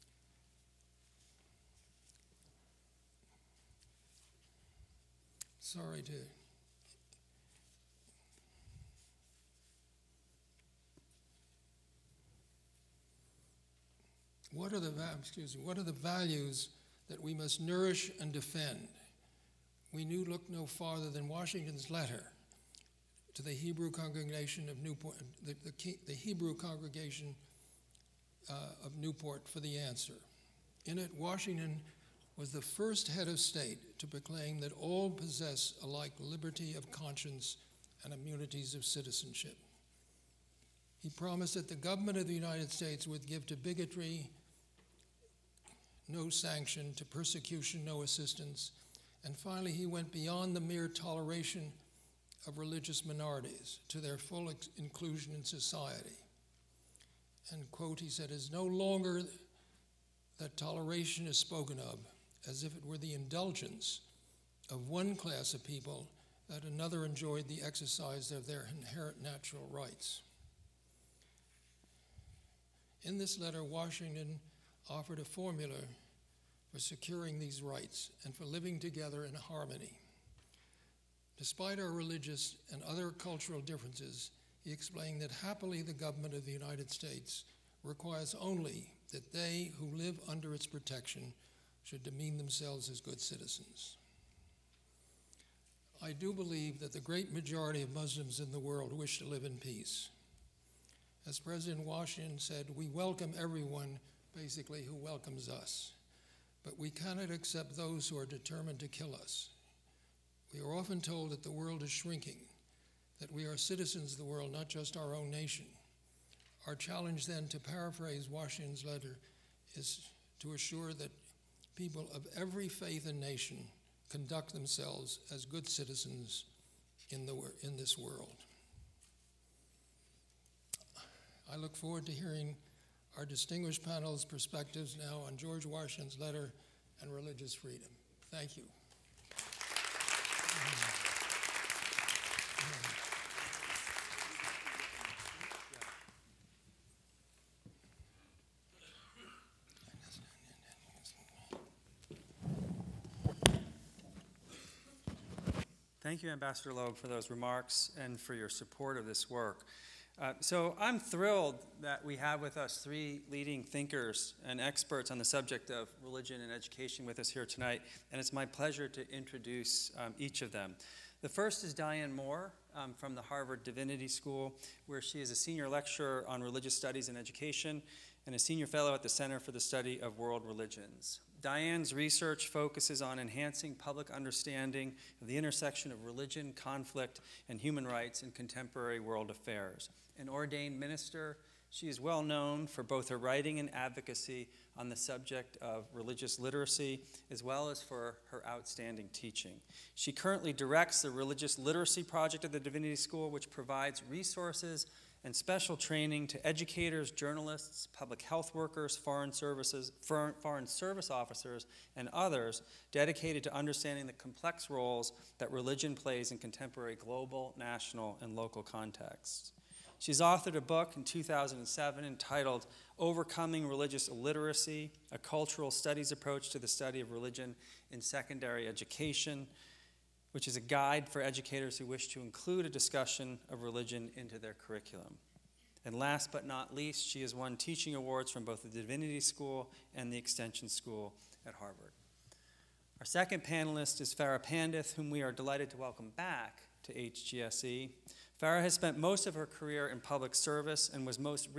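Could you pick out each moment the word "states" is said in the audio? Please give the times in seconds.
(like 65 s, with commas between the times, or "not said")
33 s, 42 s, 86 s.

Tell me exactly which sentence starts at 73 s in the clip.
In this letter, Washington offered a formula for securing these rights and for living together in harmony.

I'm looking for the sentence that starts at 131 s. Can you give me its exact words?
I look forward to hearing our distinguished panel's perspectives now on George Washington's letter and religious freedom.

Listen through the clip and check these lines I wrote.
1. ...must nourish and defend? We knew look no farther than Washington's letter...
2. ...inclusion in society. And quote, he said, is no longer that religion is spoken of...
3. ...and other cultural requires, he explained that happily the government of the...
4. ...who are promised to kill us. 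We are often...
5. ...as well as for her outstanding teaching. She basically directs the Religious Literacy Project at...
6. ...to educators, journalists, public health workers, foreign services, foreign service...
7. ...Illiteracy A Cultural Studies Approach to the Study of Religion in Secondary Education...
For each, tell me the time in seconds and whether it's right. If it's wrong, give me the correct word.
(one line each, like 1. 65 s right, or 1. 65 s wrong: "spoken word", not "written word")
1. 17 s right
2. 54 s wrong: "toleration", not "religion"
3. 82 s wrong: "differences", not "requires"
4. 108 s wrong: "determined", not "promised"
5. 197 s wrong: "currently", not "basically"
6. 206 s right
7. 224 s right.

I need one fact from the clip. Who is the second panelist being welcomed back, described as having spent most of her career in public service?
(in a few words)
Farah Pandith.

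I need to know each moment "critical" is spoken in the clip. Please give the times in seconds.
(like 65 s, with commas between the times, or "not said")
not said.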